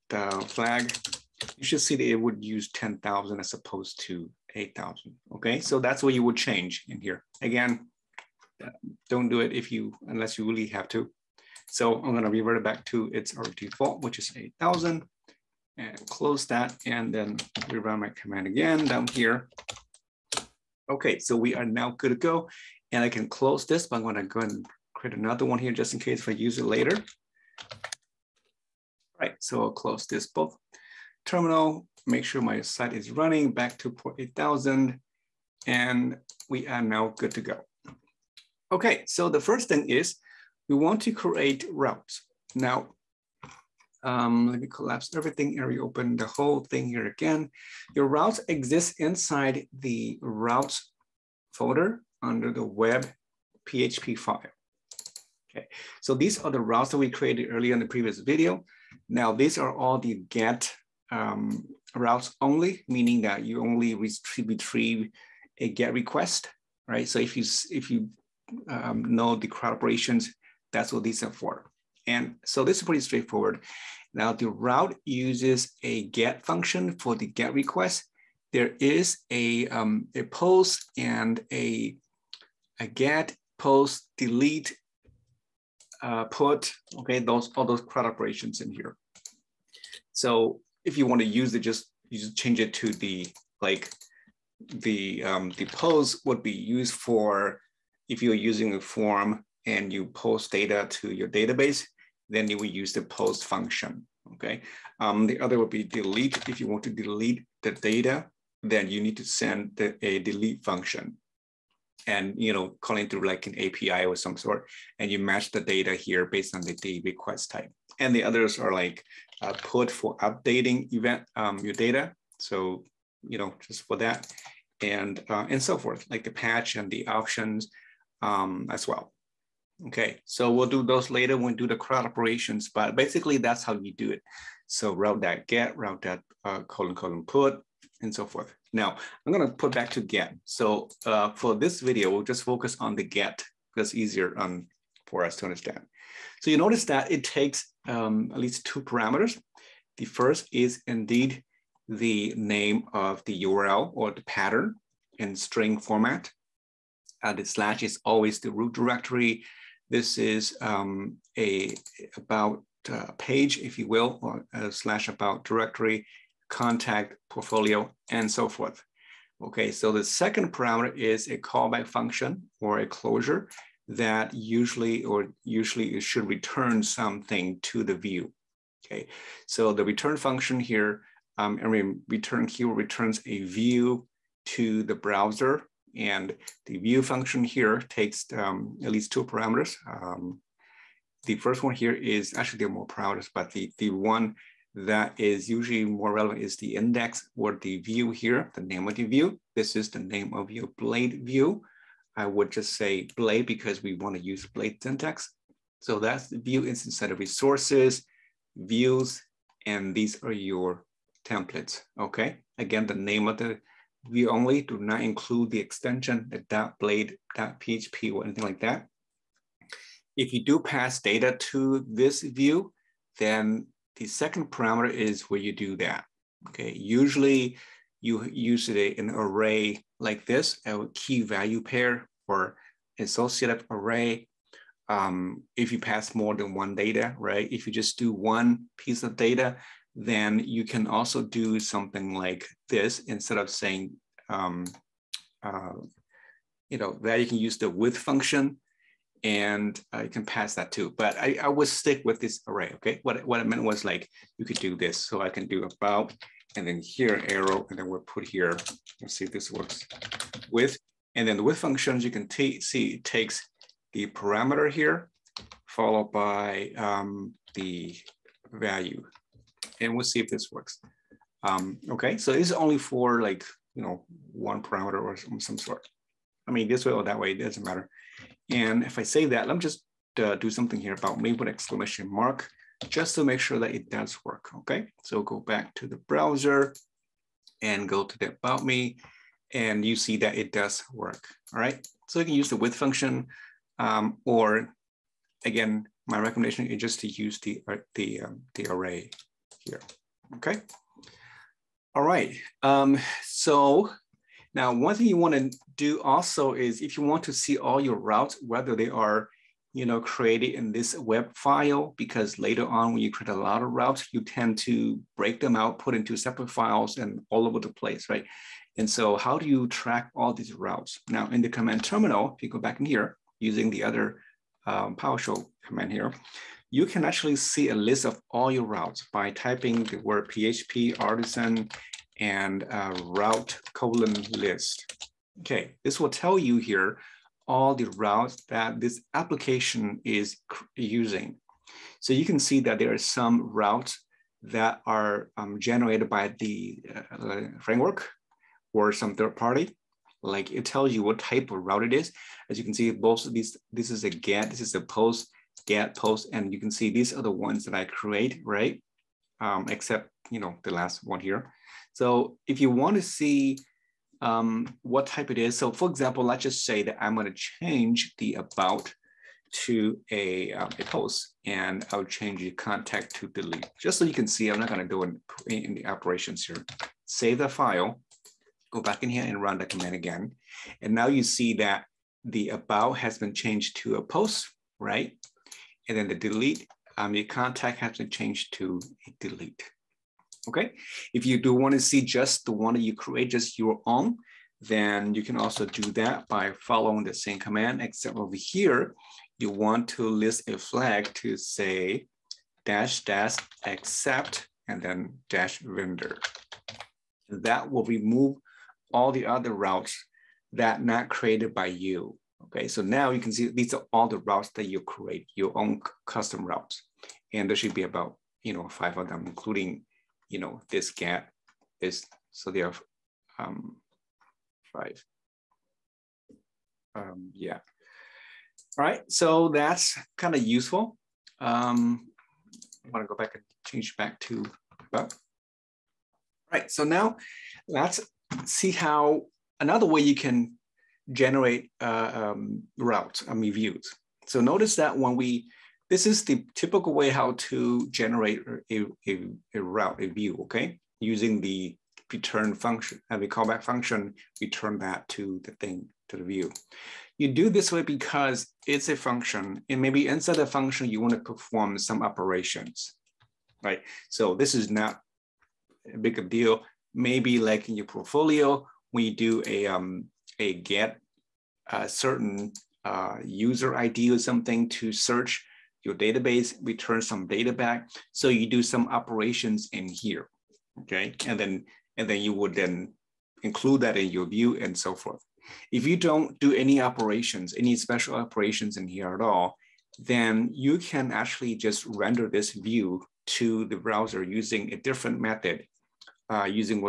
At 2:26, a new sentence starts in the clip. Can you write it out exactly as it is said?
So you notice that it takes um, at least two parameters.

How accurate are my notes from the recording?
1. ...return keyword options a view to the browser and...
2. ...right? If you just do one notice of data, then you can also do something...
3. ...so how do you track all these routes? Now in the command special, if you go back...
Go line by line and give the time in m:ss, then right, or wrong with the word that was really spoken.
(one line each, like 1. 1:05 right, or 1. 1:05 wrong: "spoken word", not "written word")
1. 3:02 wrong: "returns", not "options"
2. 3:57 wrong: "piece", not "notice"
3. 5:18 wrong: "terminal", not "special".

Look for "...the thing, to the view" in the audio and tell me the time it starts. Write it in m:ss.
7:35.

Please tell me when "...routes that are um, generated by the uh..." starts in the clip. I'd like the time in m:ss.
5:43.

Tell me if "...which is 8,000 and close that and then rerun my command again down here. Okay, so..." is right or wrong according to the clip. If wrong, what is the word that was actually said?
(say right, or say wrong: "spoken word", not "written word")
right.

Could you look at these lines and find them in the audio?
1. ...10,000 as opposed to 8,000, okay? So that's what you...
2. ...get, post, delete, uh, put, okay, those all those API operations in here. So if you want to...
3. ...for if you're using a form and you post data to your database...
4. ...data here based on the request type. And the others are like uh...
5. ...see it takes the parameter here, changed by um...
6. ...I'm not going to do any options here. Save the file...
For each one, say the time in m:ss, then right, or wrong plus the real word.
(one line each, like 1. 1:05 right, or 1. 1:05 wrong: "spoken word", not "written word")
1. 0:02 right
2. 1:22 wrong: "CRUD", not "API"
3. 1:36 right
4. 1:55 right
5. 4:22 wrong: "followed", not "changed"
6. 6:14 wrong: "operations", not "options".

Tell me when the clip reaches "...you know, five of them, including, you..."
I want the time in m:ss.
6:58.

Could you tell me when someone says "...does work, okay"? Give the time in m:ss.
4:43.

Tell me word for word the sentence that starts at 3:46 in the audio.
Okay, usually you use it an array like this, a key value pair or associative array.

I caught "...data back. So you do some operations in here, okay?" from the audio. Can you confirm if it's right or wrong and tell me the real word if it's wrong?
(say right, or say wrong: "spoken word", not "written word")
right.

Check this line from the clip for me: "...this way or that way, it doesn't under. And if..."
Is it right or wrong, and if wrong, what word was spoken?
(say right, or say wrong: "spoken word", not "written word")
wrong: "matter", not "under".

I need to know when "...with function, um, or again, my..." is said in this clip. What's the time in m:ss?
4:52.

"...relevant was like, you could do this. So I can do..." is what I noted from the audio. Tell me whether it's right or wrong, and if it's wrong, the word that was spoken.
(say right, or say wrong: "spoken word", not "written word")
wrong: "meant", not "relevant".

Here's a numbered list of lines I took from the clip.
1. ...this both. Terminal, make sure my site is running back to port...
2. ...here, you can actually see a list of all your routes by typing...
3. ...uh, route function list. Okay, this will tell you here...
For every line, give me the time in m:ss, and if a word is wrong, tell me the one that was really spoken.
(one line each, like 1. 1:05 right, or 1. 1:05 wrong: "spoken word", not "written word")
1. 0:30 right
2. 5:25 right
3. 5:32 wrong: "colon", not "function".